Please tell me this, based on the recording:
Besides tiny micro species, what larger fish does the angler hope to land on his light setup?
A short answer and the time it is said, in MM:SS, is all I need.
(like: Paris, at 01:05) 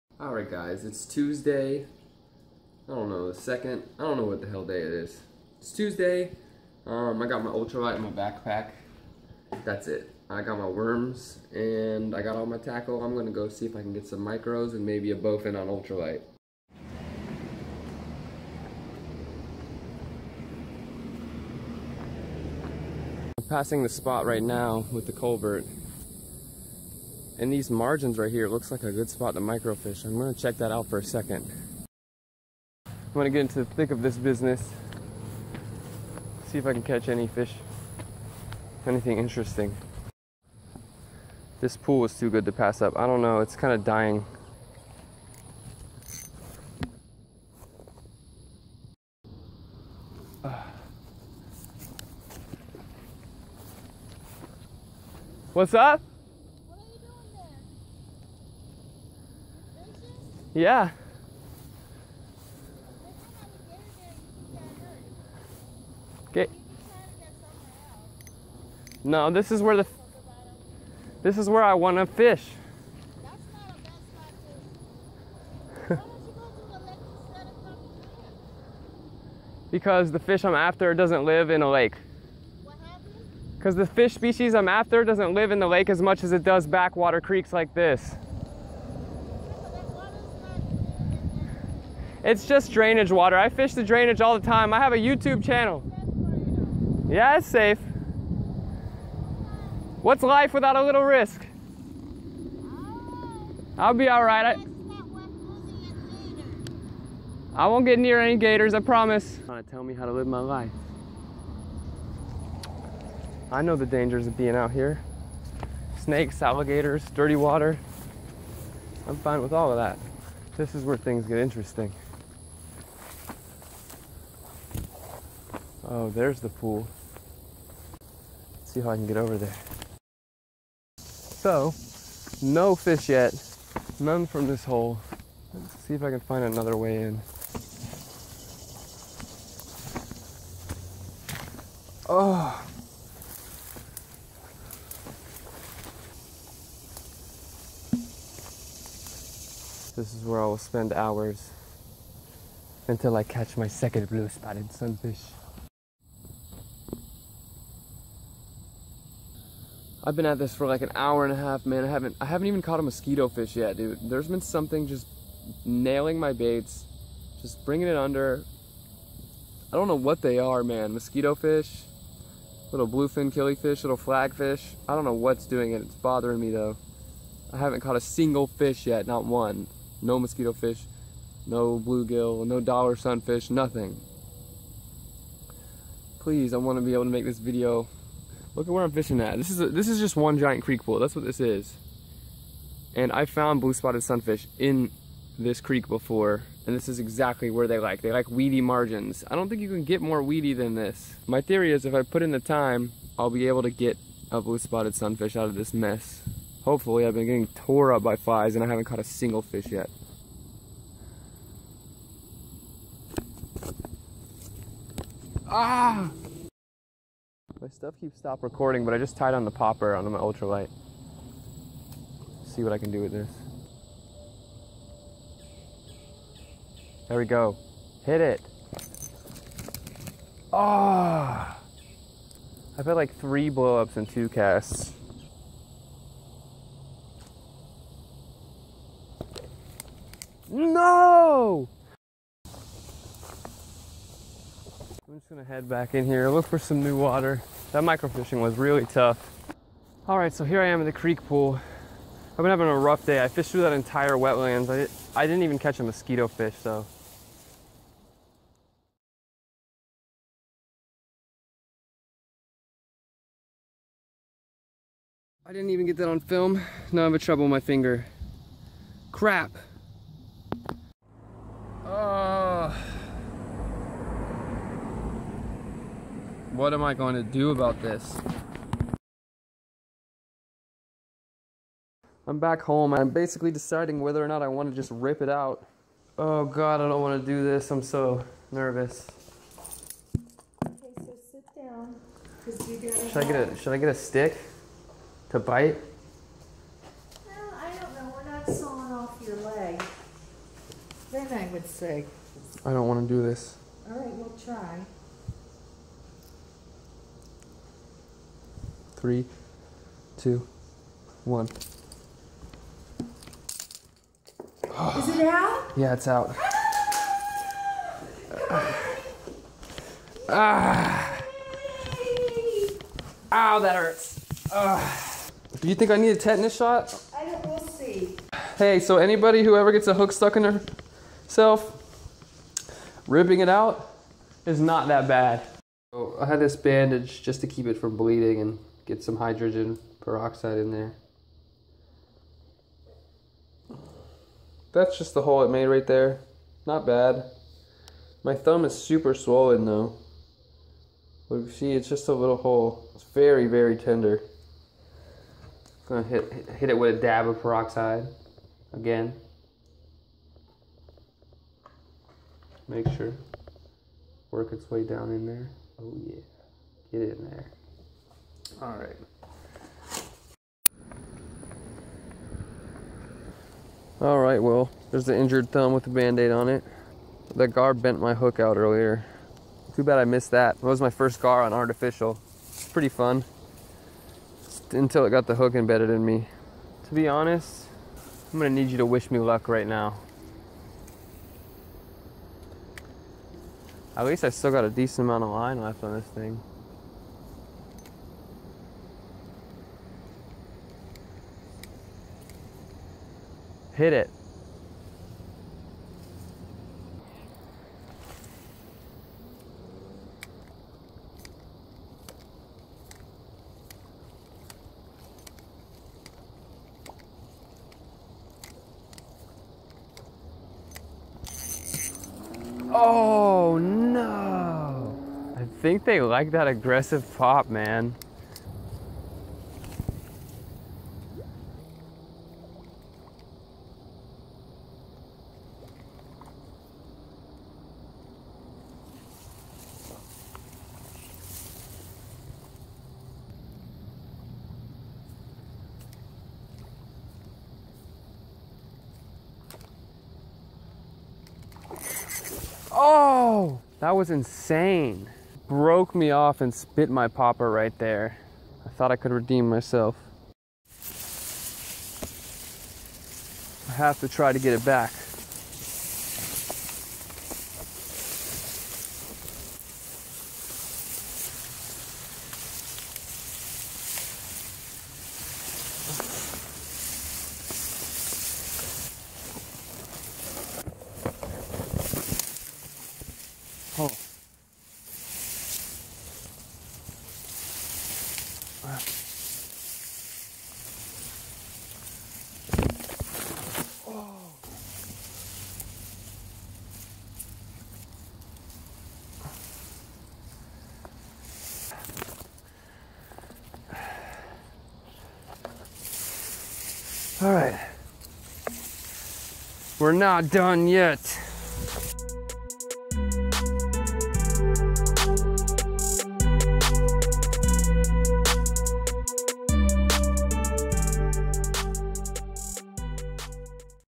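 bowfin, at 00:15.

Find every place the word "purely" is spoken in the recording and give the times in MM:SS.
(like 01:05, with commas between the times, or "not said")
not said.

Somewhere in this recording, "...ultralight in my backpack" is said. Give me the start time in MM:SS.
00:07.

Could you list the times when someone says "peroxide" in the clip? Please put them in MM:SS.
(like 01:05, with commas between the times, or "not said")
05:40, 05:57.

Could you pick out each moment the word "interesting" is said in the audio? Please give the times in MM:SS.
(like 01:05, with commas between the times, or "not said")
00:39, 02:01.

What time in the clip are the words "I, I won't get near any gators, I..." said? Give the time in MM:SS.
01:44.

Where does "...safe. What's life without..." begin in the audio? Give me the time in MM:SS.
01:37.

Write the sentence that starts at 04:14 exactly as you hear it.
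I, I didn't even catch a mosquito fish, so I didn't even get that on film.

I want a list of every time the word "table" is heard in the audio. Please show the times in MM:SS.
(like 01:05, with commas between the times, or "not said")
not said.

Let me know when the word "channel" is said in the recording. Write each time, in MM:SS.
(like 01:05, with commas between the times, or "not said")
01:35.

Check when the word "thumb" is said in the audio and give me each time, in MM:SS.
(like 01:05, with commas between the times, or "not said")
05:48, 06:15.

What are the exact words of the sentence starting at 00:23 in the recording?
I'm passing the spot right now with the culvert and these margins right here looks like a good spot to microfish.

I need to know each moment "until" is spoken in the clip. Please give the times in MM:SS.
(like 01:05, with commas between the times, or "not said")
02:32, 06:24.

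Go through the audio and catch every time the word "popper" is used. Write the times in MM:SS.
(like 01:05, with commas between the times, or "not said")
03:39, 07:37.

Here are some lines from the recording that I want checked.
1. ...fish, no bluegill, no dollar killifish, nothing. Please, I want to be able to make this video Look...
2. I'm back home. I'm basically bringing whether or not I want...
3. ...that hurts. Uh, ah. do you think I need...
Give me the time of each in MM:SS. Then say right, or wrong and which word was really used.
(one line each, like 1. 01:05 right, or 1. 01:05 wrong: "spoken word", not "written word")
1. 03:00 wrong: "sunfish", not "killifish"
2. 04:42 wrong: "deciding", not "bringing"
3. 05:23 right.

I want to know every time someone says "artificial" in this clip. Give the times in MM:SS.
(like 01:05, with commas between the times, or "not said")
06:21.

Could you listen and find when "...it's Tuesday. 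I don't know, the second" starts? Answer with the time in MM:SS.
00:00.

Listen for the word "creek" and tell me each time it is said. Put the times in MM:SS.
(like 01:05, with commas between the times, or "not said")
01:27, 03:10, 03:15, 04:10.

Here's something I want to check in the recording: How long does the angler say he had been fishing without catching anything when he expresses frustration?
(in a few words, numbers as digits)
an hour and a half.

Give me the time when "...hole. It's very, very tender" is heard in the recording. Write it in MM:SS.
05:52.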